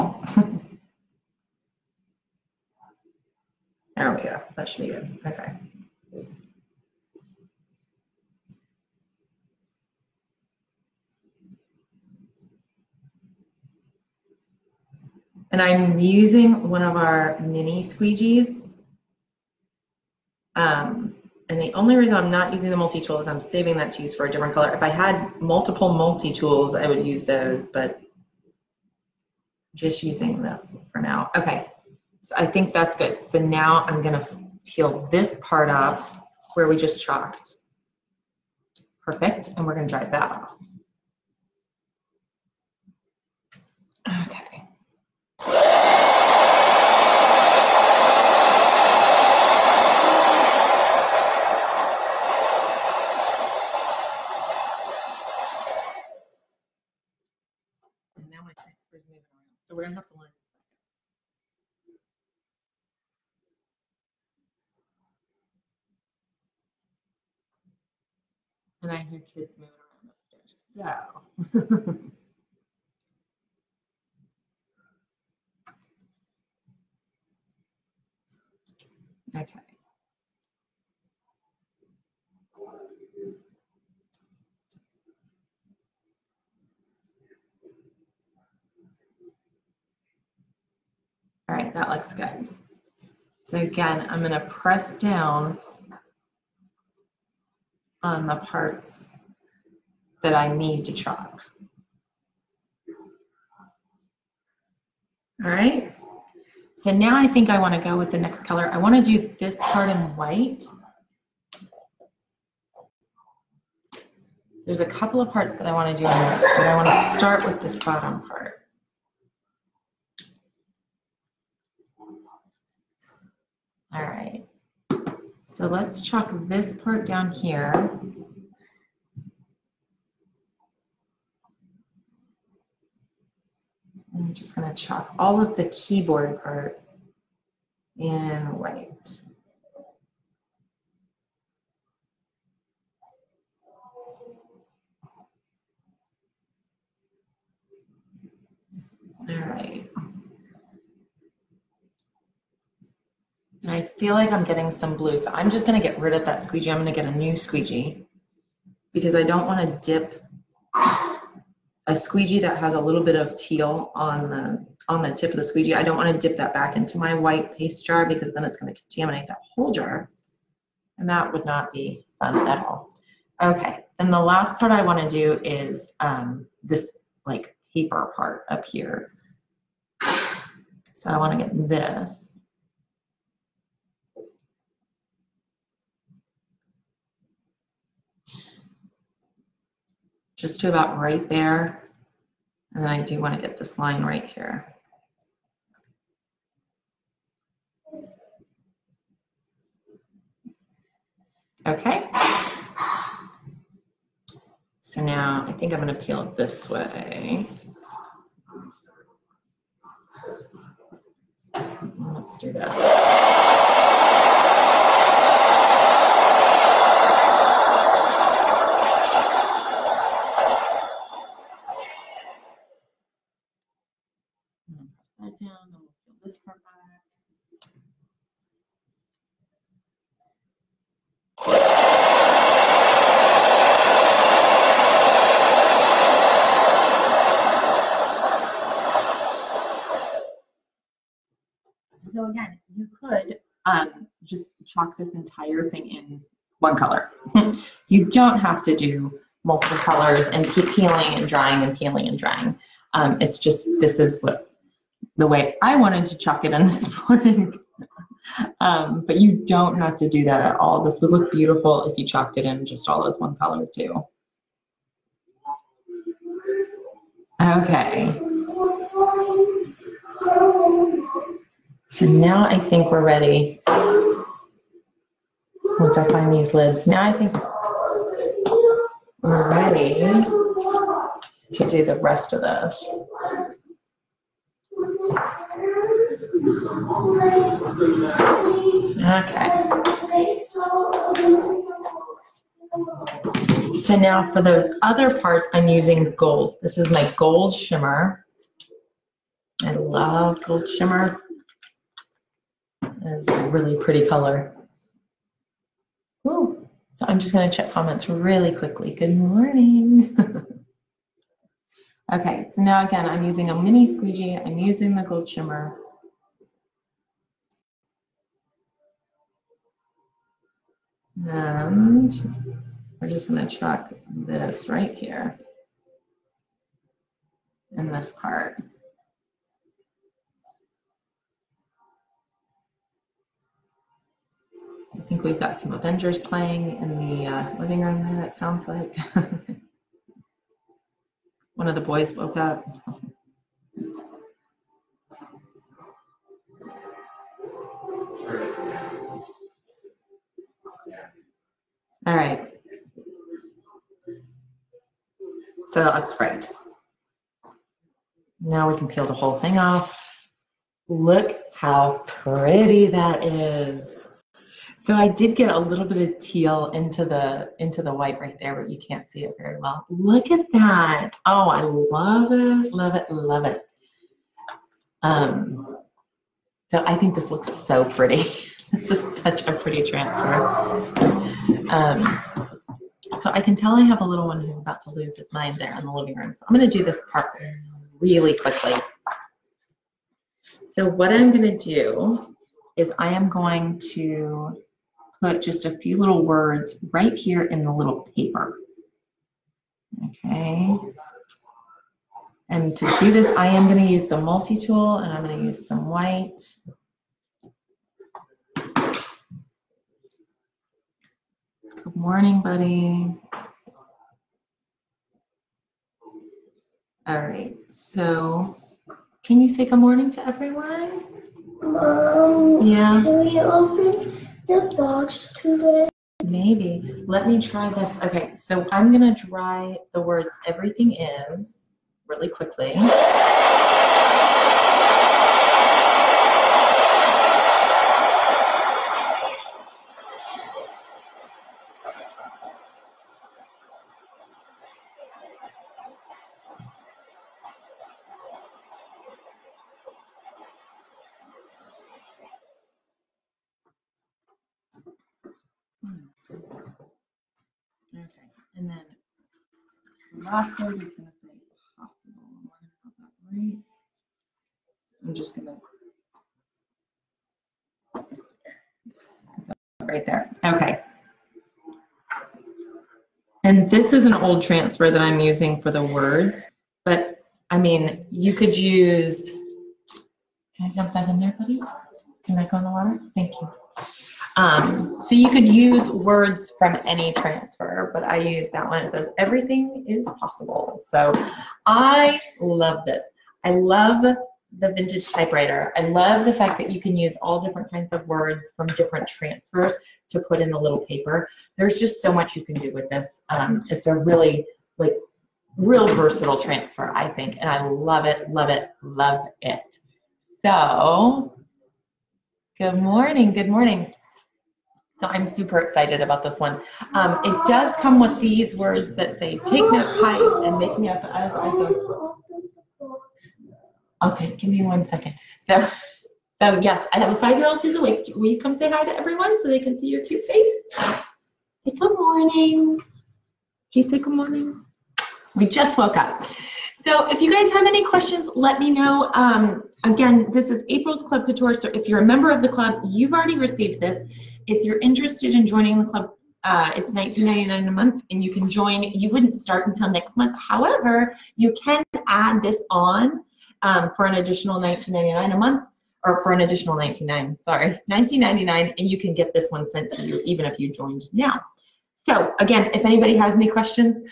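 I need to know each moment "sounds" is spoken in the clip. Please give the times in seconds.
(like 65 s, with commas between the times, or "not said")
338 s.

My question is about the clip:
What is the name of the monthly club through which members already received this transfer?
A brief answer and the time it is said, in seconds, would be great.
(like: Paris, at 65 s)
April's Club Couture, at 540 s.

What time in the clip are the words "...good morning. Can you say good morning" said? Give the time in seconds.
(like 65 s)
531 s.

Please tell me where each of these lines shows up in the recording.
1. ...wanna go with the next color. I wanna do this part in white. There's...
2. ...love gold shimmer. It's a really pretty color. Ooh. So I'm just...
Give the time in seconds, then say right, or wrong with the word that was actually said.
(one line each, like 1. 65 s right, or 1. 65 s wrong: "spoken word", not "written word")
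1. 107 s right
2. 299 s right.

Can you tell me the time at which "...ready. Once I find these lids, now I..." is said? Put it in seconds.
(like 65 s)
273 s.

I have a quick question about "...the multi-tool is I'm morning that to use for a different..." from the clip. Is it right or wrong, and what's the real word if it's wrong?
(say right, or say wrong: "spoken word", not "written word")
wrong: "saving", not "morning".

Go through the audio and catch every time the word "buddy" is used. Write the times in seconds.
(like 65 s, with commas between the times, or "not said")
412 s, 481 s.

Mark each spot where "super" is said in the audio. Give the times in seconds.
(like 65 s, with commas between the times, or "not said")
515 s.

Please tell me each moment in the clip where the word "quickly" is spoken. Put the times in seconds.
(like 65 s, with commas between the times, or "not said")
308 s, 388 s, 432 s.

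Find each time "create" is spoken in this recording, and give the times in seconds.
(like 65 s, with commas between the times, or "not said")
not said.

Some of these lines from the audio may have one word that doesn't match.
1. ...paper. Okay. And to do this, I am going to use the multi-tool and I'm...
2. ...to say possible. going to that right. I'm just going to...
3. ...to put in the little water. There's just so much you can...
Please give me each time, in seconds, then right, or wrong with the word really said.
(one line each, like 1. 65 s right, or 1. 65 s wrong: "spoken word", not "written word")
1. 398 s right
2. 460 s right
3. 500 s wrong: "paper", not "water".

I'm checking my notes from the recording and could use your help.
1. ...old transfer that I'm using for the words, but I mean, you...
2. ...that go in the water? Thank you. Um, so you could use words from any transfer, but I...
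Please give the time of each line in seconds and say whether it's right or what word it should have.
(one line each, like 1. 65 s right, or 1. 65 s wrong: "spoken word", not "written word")
1. 474 s right
2. 482 s right.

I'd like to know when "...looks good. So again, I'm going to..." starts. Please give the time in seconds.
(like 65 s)
91 s.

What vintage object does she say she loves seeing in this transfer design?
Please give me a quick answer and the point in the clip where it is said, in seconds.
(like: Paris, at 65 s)
typewriter, at 495 s.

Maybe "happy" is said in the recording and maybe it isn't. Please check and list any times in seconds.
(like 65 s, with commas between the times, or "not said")
not said.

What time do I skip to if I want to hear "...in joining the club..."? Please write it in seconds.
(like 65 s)
545 s.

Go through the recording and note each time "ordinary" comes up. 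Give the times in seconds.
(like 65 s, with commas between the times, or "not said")
not said.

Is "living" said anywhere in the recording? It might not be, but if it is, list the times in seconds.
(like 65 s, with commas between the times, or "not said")
337 s, 385 s.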